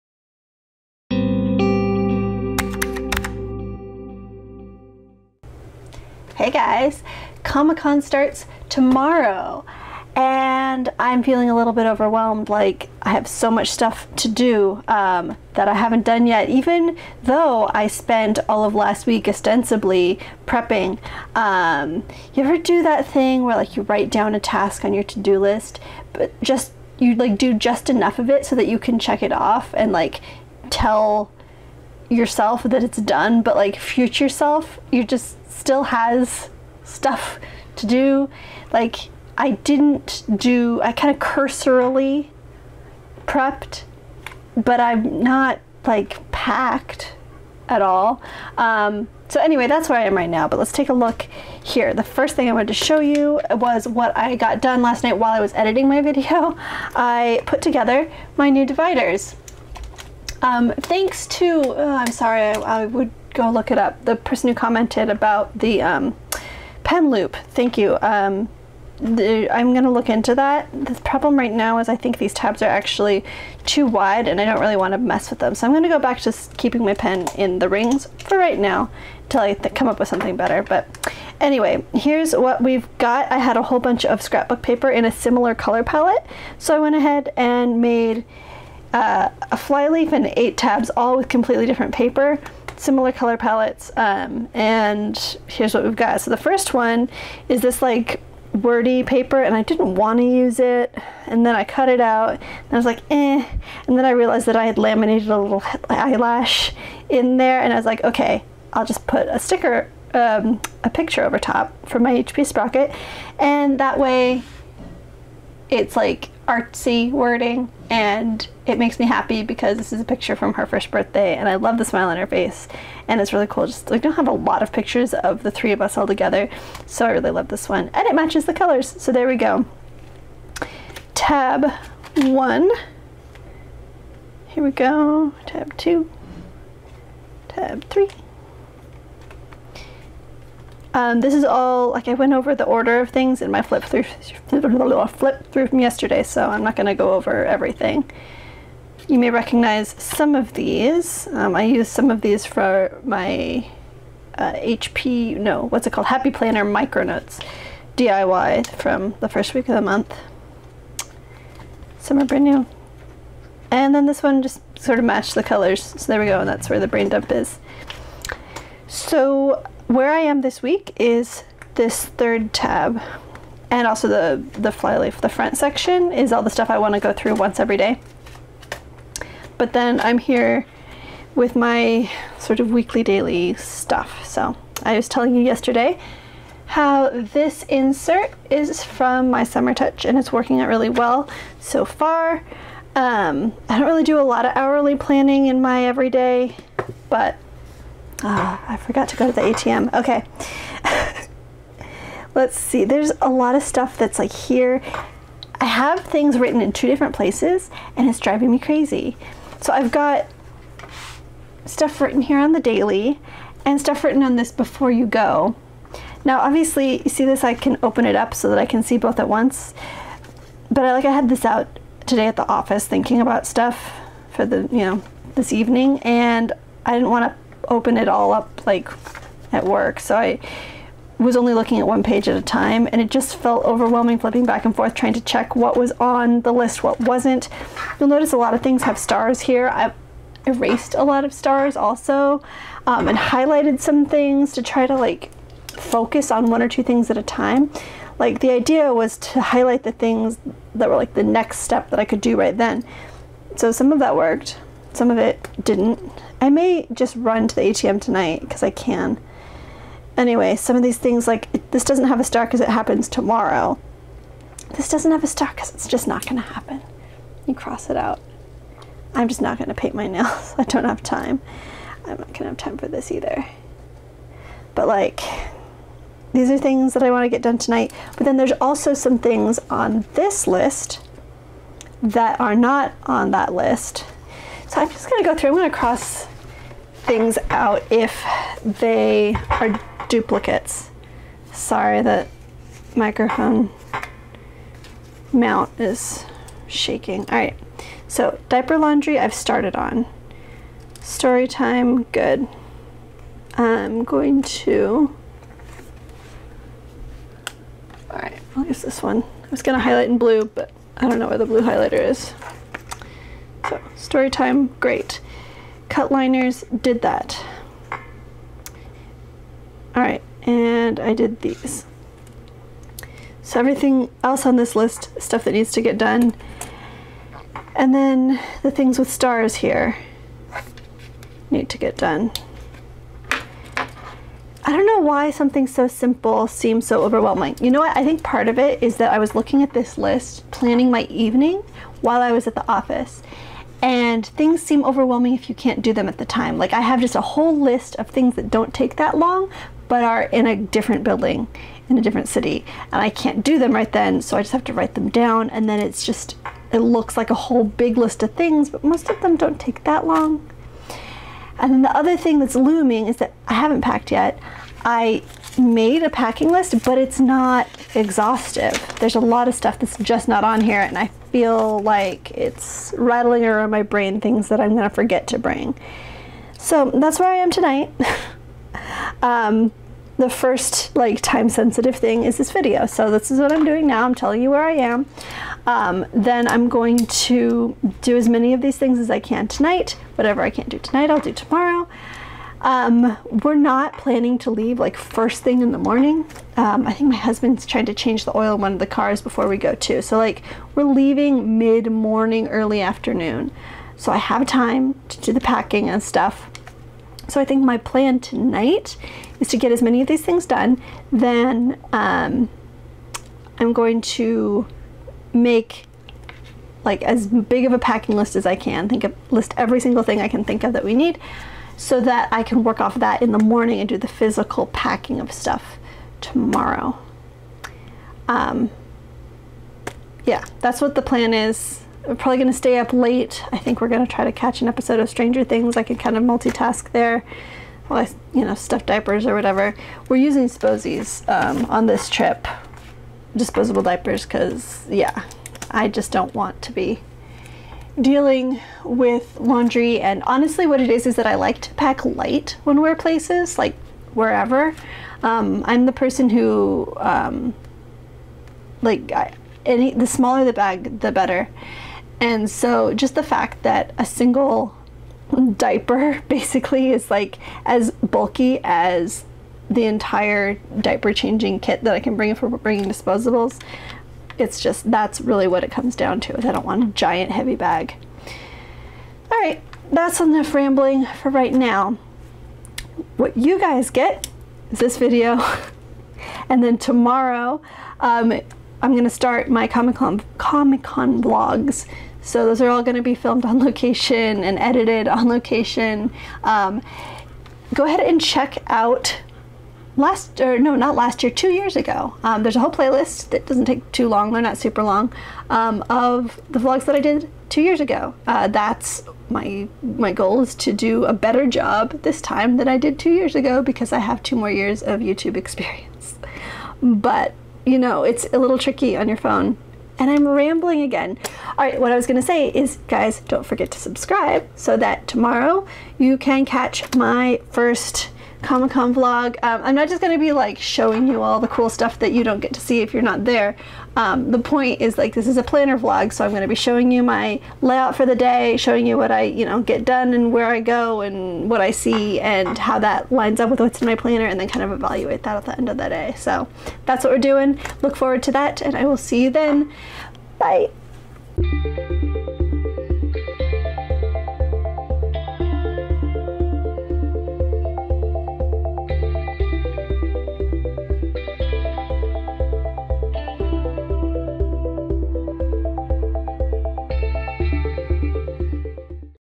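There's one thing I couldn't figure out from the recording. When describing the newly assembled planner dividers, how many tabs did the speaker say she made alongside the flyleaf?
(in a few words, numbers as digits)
8.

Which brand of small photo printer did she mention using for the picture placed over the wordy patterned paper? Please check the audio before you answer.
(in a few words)
HP Sprocket.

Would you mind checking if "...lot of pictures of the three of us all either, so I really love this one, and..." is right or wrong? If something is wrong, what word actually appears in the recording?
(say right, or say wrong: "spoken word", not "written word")
wrong: "together", not "either".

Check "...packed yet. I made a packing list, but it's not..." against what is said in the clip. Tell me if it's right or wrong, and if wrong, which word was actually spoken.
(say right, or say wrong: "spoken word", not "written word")
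right.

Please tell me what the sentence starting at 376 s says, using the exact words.
So that's where I am tonight.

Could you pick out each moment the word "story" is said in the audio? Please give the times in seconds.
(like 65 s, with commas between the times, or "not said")
301 s, 313 s.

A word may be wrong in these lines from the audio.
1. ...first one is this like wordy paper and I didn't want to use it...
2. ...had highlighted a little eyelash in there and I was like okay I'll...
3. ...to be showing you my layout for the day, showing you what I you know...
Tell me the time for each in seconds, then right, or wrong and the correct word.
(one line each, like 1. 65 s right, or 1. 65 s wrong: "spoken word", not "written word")
1. 96 s right
2. 104 s wrong: "laminated", not "highlighted"
3. 536 s right.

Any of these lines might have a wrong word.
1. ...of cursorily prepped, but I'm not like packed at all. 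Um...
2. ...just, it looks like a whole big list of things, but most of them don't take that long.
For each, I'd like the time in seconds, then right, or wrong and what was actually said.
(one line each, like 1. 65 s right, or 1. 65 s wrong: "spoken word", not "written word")
1. 41 s right
2. 356 s right.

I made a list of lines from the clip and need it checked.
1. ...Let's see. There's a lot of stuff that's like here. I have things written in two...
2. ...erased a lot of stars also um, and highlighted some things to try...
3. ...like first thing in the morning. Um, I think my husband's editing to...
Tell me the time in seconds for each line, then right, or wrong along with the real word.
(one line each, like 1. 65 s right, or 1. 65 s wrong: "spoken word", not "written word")
1. 202 s right
2. 240 s right
3. 394 s wrong: "trying", not "editing".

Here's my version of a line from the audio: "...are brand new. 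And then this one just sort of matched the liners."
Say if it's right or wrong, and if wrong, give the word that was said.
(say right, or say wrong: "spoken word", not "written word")
wrong: "colors", not "liners".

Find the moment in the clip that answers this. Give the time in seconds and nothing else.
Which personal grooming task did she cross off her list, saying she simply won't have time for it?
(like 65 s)
269 s.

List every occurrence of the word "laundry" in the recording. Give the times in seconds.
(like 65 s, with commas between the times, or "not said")
298 s, 449 s.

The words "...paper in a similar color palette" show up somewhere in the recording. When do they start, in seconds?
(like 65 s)
84 s.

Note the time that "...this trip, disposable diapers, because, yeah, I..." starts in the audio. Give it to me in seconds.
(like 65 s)
441 s.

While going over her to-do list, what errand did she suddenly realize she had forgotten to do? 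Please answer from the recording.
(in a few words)
Go to the ATM.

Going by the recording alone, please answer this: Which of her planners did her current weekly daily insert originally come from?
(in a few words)
Summer Touch.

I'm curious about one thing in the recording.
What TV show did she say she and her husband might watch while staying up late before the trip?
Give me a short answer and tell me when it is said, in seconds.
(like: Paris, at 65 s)
Stranger Things, at 435 s.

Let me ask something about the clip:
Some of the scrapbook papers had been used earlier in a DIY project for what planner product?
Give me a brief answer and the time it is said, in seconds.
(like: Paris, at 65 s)
Happy Planner Micronotes, at 156 s.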